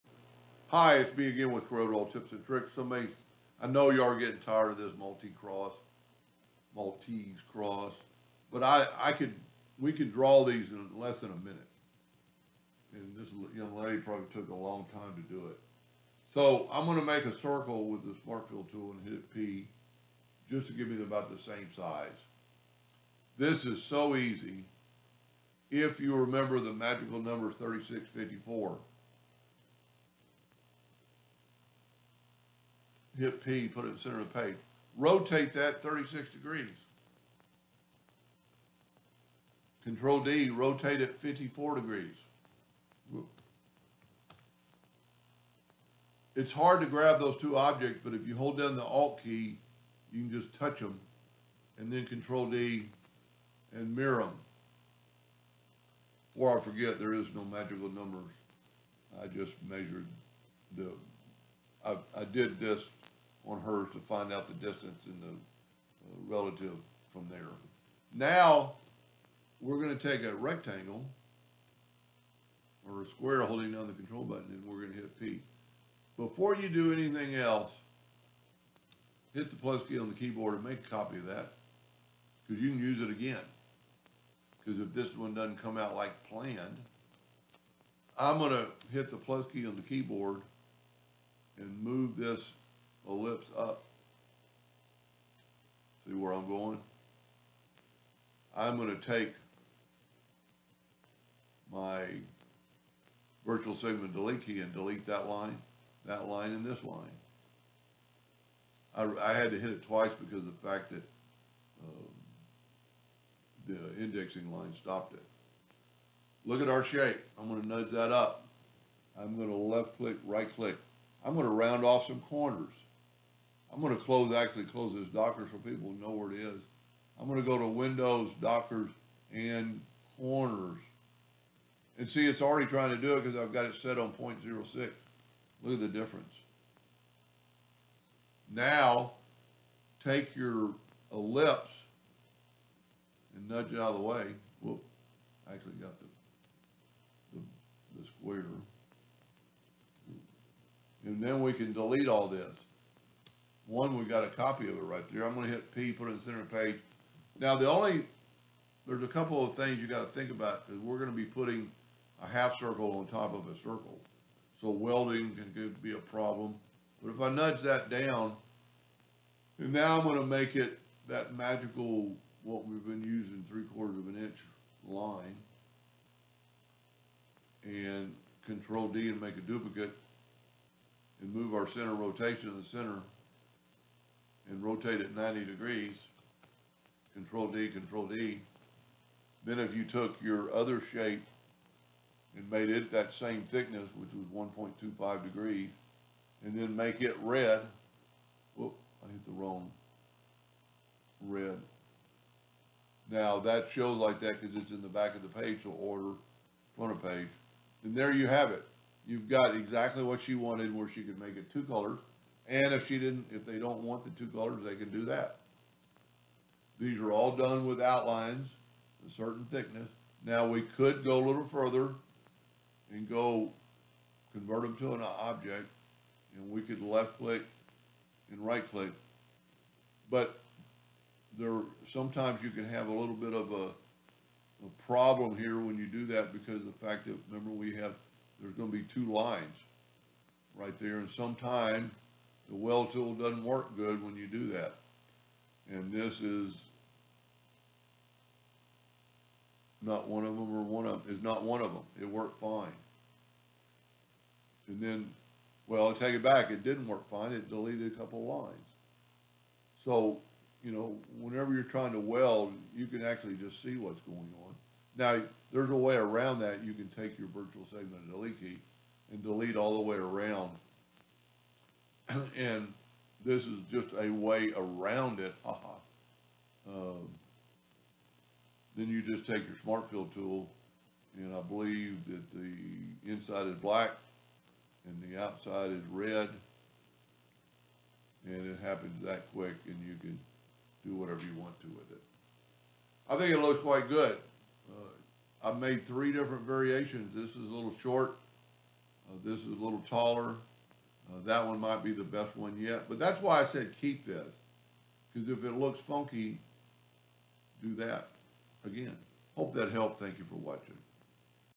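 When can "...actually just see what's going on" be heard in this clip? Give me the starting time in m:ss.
4:23.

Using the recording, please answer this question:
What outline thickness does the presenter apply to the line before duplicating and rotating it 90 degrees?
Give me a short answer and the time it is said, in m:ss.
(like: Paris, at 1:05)
three quarters of an inch, at 2:53.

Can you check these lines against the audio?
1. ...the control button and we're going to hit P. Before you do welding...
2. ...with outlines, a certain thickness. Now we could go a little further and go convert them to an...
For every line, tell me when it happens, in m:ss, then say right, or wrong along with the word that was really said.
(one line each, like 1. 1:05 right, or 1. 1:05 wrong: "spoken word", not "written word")
1. 1:13 wrong: "anything", not "welding"
2. 3:37 right.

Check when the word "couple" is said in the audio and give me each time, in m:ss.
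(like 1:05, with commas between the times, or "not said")
2:39, 4:17.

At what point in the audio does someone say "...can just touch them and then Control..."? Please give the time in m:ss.
0:50.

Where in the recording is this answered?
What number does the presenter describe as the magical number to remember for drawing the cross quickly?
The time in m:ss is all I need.
0:27.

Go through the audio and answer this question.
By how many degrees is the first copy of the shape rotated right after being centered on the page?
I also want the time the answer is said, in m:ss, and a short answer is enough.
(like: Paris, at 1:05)
36, at 0:35.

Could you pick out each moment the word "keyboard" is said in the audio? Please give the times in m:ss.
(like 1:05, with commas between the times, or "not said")
1:20, 1:29.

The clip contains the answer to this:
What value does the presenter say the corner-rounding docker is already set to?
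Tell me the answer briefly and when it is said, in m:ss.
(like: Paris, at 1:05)
0.06, at 2:14.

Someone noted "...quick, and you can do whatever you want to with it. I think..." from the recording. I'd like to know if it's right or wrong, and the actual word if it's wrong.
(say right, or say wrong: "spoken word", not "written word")
right.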